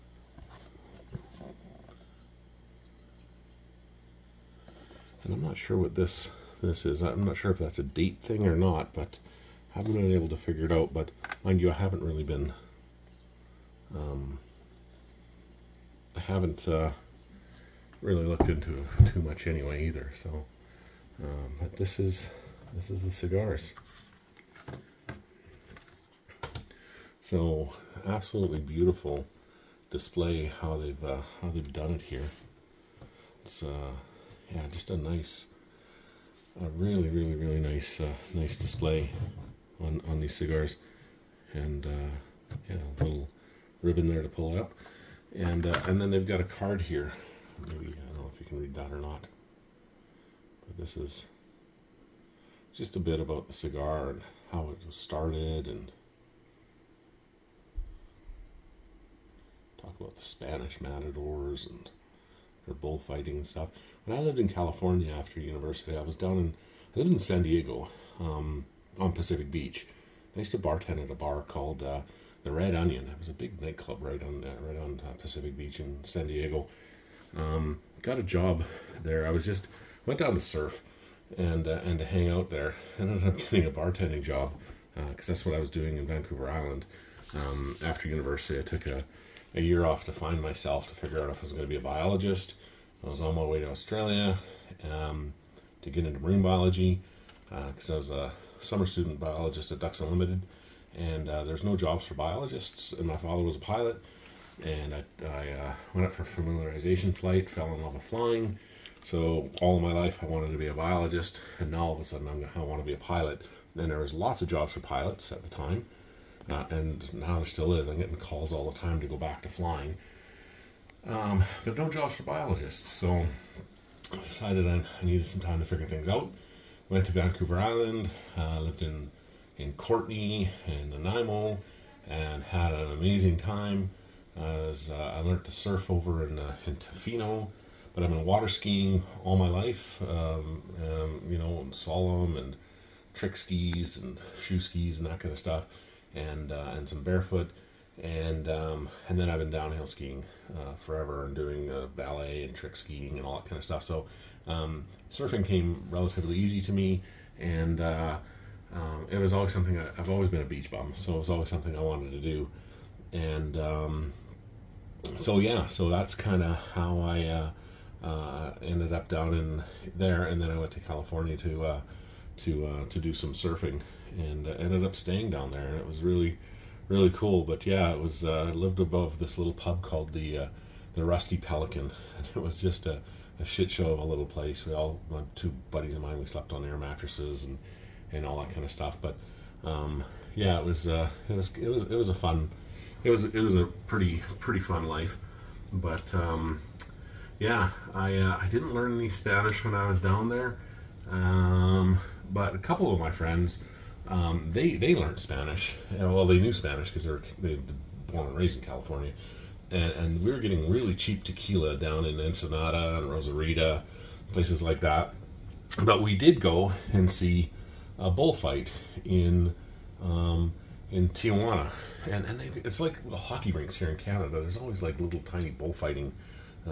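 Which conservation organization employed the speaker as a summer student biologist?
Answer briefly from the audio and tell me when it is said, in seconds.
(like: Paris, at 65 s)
Ducks Unlimited, at 99 s.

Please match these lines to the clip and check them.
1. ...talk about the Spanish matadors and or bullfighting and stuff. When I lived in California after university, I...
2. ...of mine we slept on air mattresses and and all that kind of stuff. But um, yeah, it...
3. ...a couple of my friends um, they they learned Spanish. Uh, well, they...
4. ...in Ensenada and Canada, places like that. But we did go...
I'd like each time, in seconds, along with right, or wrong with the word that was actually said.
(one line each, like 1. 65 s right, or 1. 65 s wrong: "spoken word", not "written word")
1. 59 s right
2. 185 s right
3. 202 s right
4. 212 s wrong: "Rosarita", not "Canada".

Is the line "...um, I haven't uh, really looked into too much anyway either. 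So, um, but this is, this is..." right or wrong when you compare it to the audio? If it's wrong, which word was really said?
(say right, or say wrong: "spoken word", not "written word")
right.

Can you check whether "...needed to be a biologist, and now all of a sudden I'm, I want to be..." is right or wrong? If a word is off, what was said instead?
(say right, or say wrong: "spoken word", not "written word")
wrong: "wanted", not "needed".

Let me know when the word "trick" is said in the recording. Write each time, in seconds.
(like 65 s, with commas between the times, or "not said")
143 s, 152 s.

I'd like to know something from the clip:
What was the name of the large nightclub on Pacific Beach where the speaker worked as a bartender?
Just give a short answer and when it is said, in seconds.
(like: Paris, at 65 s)
The Red Onion, at 72 s.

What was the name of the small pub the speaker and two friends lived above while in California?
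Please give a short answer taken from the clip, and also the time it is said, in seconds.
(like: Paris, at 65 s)
The Rusty Pelican, at 180 s.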